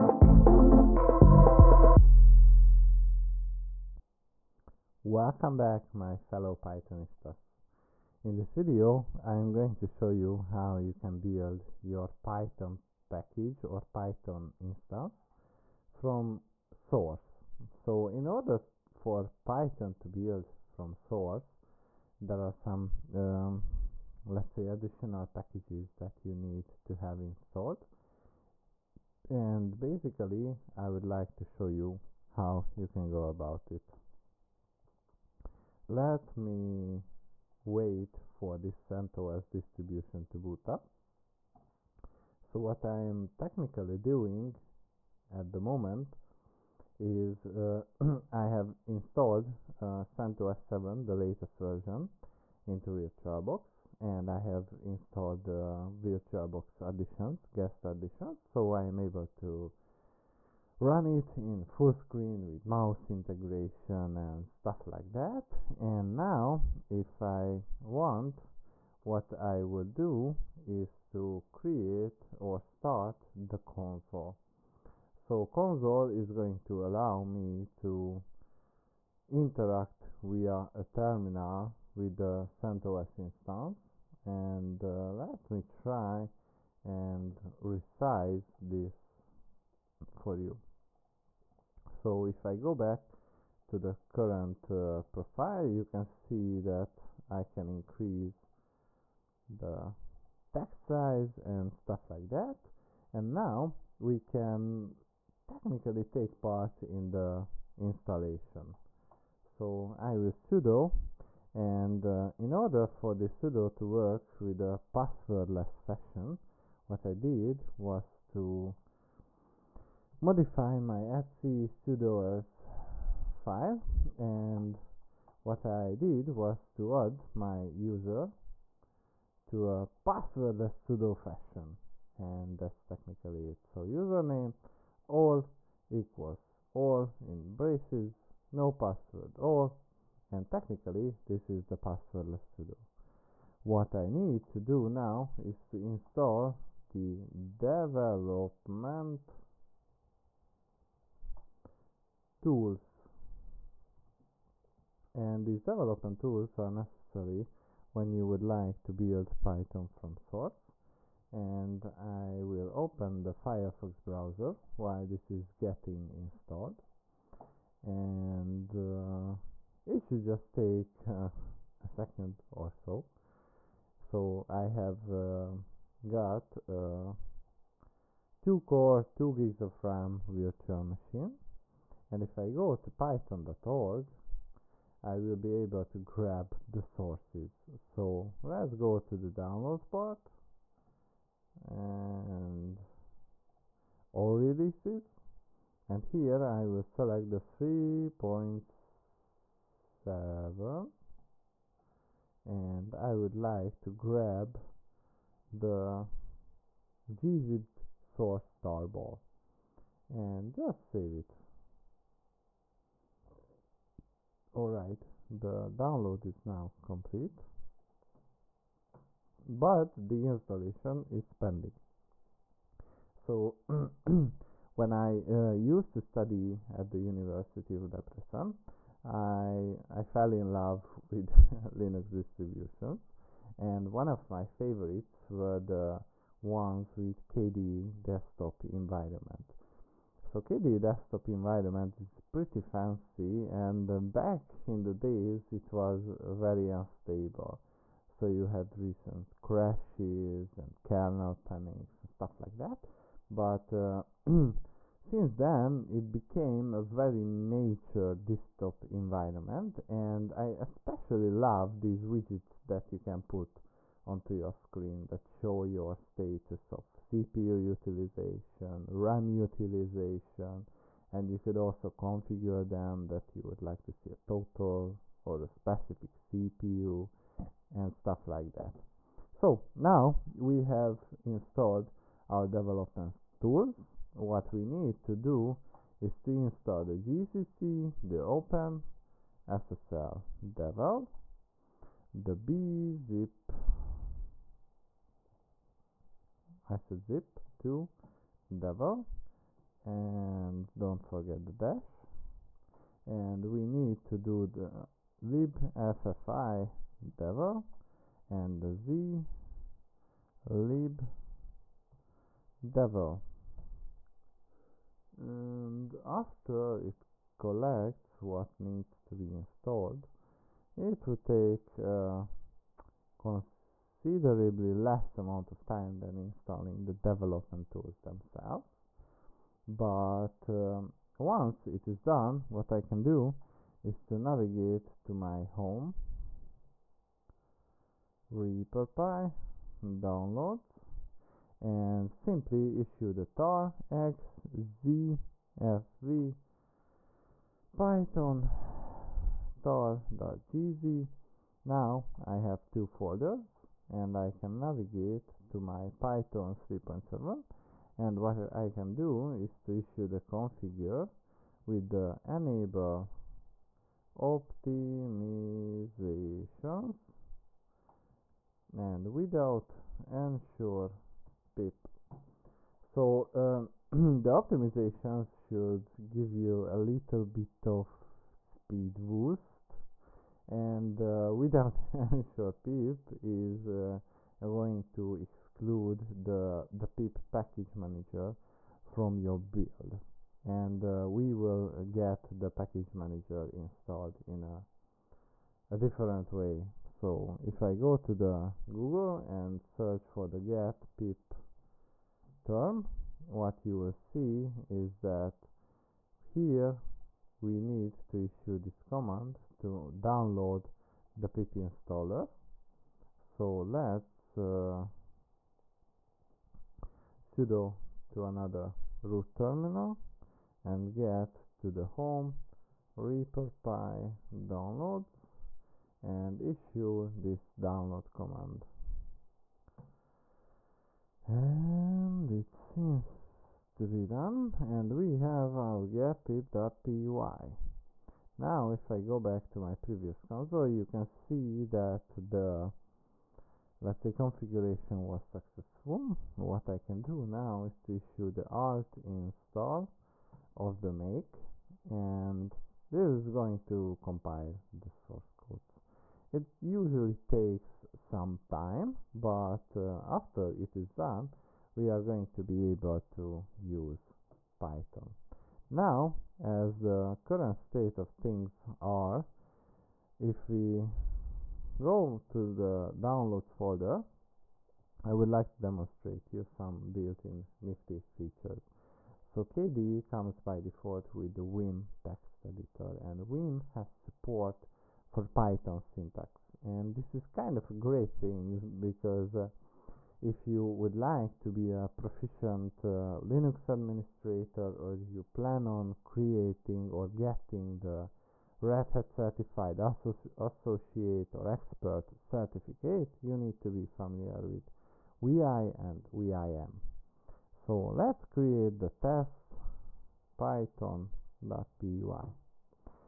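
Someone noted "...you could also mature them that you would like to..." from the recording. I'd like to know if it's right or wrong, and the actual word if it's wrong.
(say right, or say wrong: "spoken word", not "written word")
wrong: "configure", not "mature".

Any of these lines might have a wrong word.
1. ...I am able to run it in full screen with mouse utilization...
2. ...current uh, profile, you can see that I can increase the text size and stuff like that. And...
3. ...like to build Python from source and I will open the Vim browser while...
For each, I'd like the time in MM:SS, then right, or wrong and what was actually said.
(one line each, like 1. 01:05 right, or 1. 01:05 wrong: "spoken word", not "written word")
1. 00:58 wrong: "integration", not "utilization"
2. 01:34 right
3. 02:38 wrong: "Firefox", not "Vim".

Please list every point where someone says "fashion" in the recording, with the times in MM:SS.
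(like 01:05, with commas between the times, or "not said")
01:55, 02:11.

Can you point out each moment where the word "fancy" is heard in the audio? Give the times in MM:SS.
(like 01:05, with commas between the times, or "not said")
04:02.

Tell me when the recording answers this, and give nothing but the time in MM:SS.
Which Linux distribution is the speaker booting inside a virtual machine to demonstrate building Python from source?
00:50.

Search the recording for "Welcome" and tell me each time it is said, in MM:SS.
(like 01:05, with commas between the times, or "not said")
00:05.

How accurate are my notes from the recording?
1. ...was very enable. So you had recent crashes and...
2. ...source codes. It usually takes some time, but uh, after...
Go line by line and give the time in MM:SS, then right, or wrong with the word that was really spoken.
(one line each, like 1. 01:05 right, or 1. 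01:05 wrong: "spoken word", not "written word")
1. 04:05 wrong: "unstable", not "enable"
2. 07:34 right.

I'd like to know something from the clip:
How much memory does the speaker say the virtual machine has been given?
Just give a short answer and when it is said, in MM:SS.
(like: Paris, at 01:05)
2 GB, at 02:59.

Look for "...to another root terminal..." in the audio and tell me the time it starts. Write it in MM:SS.
06:58.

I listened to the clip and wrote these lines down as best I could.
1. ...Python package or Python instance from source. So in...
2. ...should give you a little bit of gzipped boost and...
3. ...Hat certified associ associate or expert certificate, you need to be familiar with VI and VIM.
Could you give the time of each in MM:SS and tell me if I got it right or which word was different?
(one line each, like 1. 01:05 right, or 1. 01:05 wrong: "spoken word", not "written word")
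1. 00:12 right
2. 06:15 wrong: "speed", not "gzipped"
3. 08:18 right.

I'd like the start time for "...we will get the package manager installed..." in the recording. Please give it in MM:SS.
06:31.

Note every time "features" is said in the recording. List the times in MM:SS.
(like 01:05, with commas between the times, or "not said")
07:58.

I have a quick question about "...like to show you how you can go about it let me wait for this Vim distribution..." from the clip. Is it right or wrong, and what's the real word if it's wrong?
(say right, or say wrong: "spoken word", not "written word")
wrong: "CentOS", not "Vim".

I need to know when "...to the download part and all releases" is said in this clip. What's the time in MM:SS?
03:08.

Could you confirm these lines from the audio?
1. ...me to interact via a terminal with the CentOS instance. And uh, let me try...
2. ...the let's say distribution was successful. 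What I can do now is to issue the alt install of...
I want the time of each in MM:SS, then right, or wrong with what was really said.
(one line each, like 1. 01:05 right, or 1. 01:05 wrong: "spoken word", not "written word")
1. 01:17 right
2. 07:22 wrong: "configuration", not "distribution".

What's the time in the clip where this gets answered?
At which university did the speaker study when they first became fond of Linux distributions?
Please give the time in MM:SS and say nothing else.
03:46.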